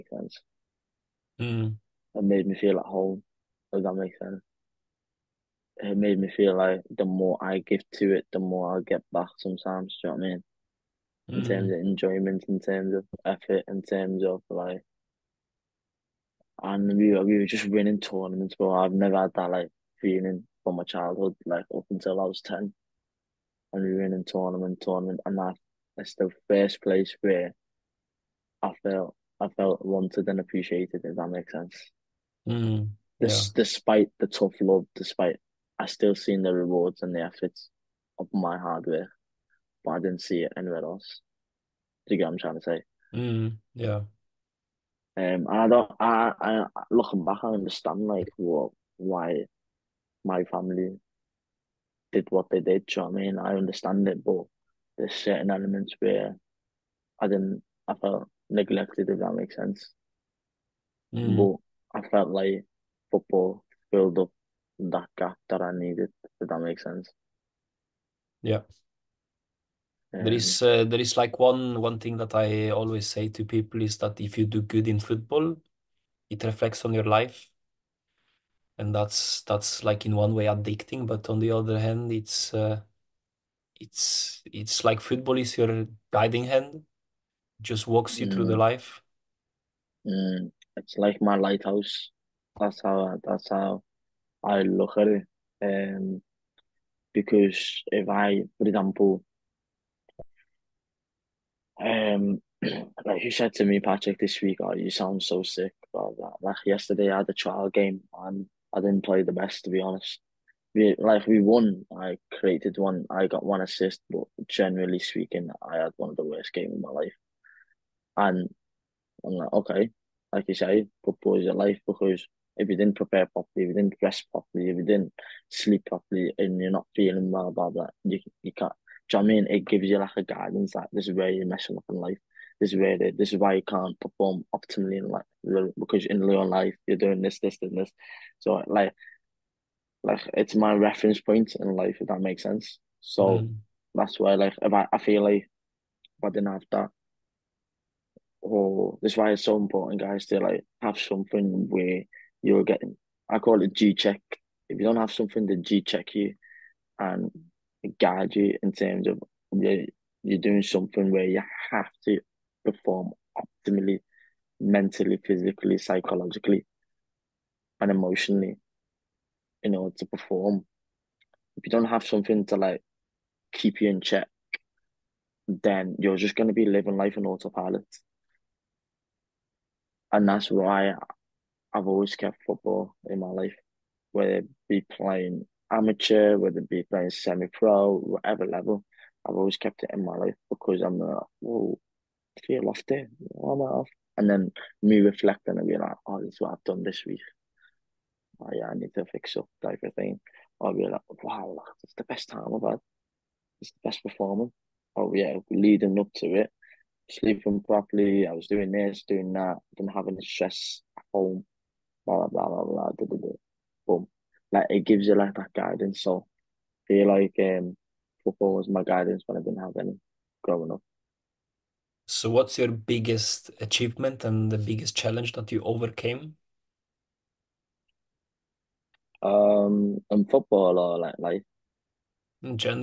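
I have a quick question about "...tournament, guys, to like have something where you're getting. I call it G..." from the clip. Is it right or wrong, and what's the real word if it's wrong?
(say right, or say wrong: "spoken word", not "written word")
wrong: "important", not "tournament".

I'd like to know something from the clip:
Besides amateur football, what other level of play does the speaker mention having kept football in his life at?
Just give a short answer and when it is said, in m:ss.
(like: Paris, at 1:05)
semi pro, at 3:07.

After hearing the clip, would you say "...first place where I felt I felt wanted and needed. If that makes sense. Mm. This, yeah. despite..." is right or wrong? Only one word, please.
wrong.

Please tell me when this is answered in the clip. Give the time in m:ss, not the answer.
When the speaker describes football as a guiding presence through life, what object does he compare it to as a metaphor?
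1:31.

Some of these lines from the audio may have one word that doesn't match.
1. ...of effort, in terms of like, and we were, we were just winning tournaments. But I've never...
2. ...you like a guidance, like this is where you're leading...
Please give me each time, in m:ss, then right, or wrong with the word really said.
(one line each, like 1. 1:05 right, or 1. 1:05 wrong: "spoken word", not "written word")
1. 0:12 right
2. 2:09 wrong: "messing", not "leading".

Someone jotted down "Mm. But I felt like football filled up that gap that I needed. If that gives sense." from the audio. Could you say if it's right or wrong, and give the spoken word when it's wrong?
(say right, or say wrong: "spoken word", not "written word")
wrong: "makes", not "gives".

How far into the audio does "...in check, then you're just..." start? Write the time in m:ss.
2:53.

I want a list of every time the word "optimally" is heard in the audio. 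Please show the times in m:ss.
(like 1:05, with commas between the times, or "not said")
2:14, 2:43.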